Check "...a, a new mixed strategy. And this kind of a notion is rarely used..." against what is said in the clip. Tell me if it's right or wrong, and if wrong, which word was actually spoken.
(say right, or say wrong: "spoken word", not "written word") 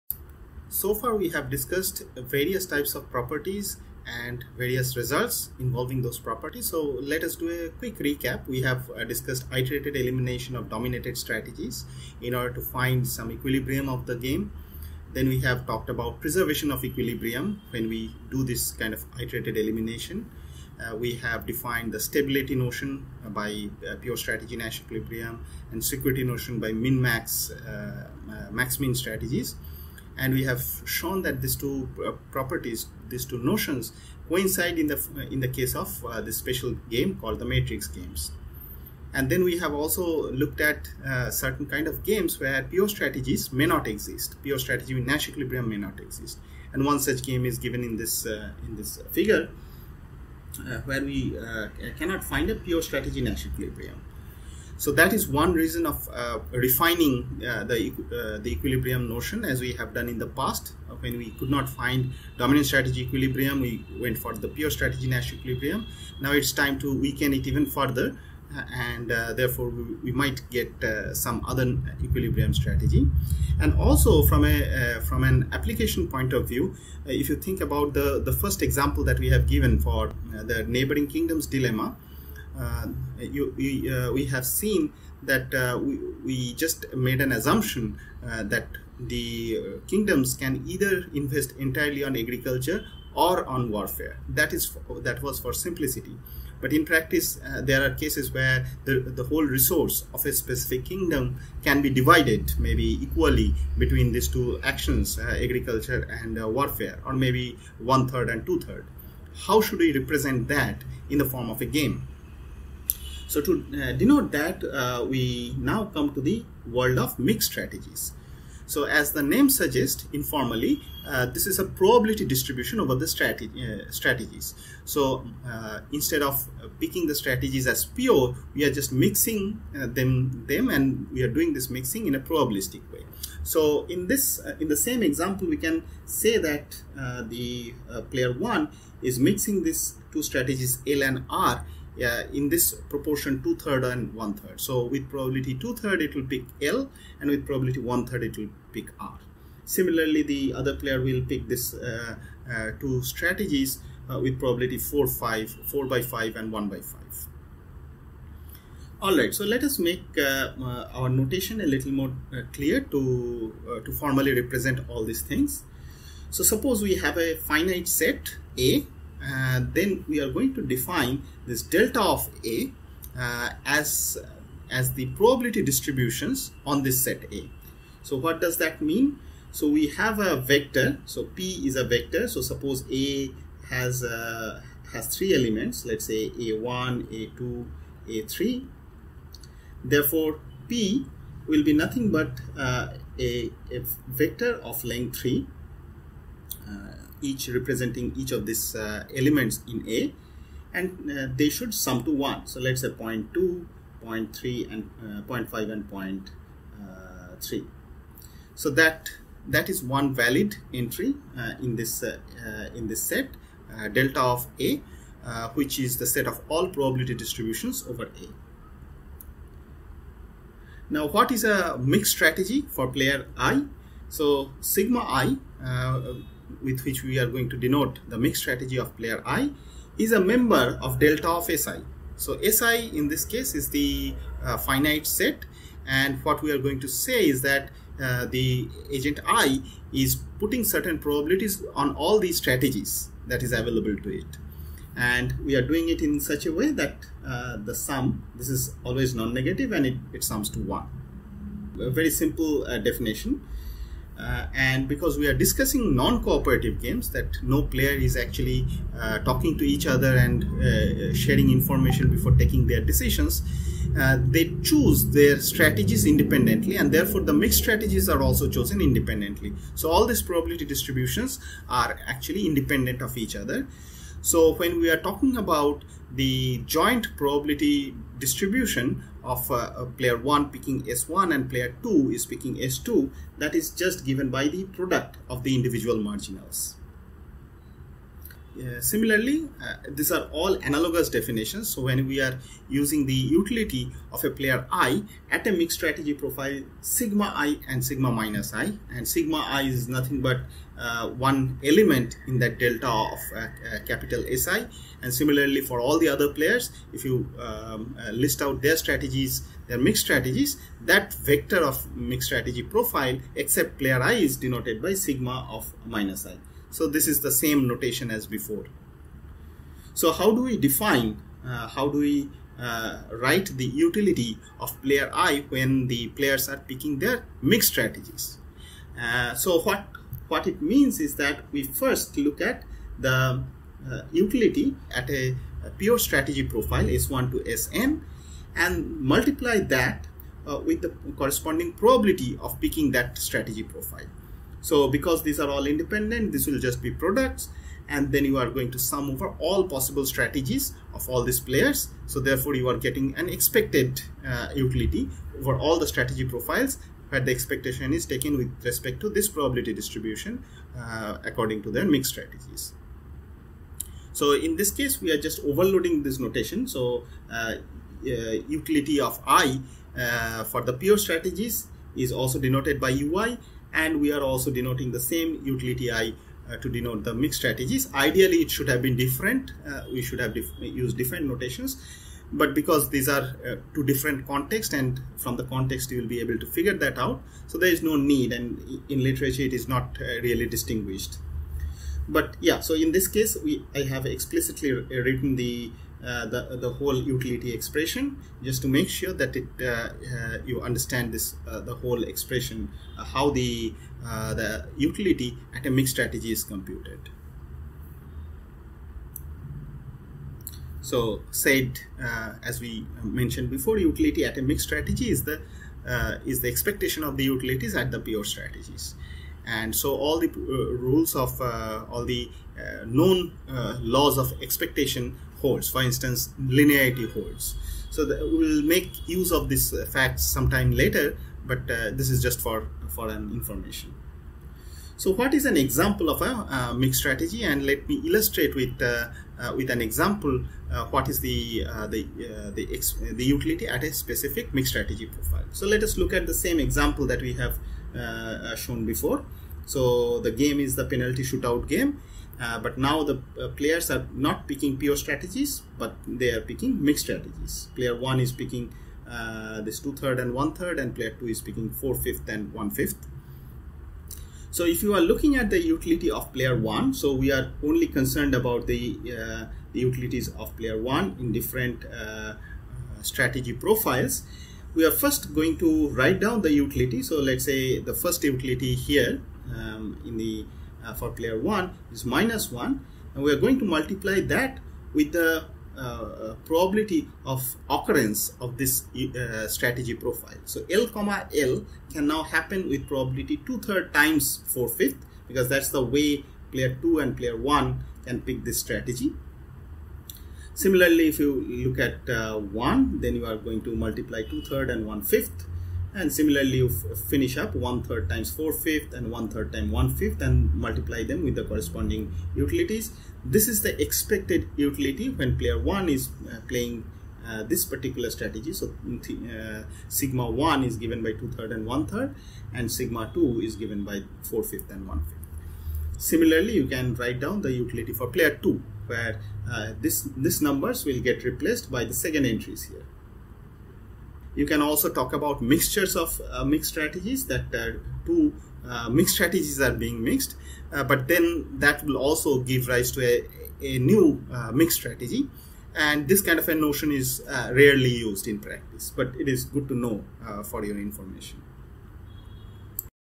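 right.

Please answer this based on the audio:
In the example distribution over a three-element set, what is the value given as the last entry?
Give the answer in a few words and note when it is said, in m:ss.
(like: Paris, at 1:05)
0.5, at 3:25.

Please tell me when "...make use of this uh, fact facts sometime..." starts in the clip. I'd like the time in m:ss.
7:08.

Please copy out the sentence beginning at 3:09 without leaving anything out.
Therefore, P will be nothing but uh, a, a, vector of length 3.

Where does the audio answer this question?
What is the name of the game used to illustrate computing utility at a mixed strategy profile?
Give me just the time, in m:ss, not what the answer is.
7:30.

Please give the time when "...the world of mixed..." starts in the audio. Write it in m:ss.
1:56.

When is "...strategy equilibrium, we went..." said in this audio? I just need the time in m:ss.
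1:02.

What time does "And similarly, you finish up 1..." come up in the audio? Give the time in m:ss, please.
8:25.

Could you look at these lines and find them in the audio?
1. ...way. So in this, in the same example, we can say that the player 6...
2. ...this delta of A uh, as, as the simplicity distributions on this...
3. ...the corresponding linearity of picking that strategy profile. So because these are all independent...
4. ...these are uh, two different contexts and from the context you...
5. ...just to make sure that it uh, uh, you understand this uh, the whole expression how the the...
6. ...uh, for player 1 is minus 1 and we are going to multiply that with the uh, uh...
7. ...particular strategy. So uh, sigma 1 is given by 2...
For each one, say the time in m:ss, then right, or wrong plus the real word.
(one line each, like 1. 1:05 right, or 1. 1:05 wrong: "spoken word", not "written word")
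1. 2:12 wrong: "1", not "6"
2. 2:51 wrong: "probability", not "simplicity"
3. 5:40 wrong: "probability", not "linearity"
4. 6:22 right
5. 6:38 right
6. 8:00 right
7. 8:37 right.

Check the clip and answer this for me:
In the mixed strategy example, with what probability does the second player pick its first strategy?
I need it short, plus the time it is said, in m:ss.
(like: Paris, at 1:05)
4/5, at 2:35.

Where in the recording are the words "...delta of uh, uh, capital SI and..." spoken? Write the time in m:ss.
5:02.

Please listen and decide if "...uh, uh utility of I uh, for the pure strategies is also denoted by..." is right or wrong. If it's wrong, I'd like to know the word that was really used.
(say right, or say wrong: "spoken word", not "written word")
right.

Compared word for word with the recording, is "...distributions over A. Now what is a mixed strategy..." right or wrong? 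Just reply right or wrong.
right.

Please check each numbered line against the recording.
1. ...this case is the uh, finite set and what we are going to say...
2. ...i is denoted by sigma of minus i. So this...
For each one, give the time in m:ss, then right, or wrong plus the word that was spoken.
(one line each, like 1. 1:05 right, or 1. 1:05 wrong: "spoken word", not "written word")
1. 3:53 right
2. 5:14 right.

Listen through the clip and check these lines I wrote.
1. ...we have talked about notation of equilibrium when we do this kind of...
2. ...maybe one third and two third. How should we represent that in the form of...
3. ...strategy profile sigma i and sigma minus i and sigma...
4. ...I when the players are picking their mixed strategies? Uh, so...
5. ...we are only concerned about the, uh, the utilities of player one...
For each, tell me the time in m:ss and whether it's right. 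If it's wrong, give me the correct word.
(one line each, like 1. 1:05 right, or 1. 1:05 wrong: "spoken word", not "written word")
1. 0:15 wrong: "preservation", not "notation"
2. 1:47 right
3. 4:55 right
4. 5:25 right
5. 7:47 right.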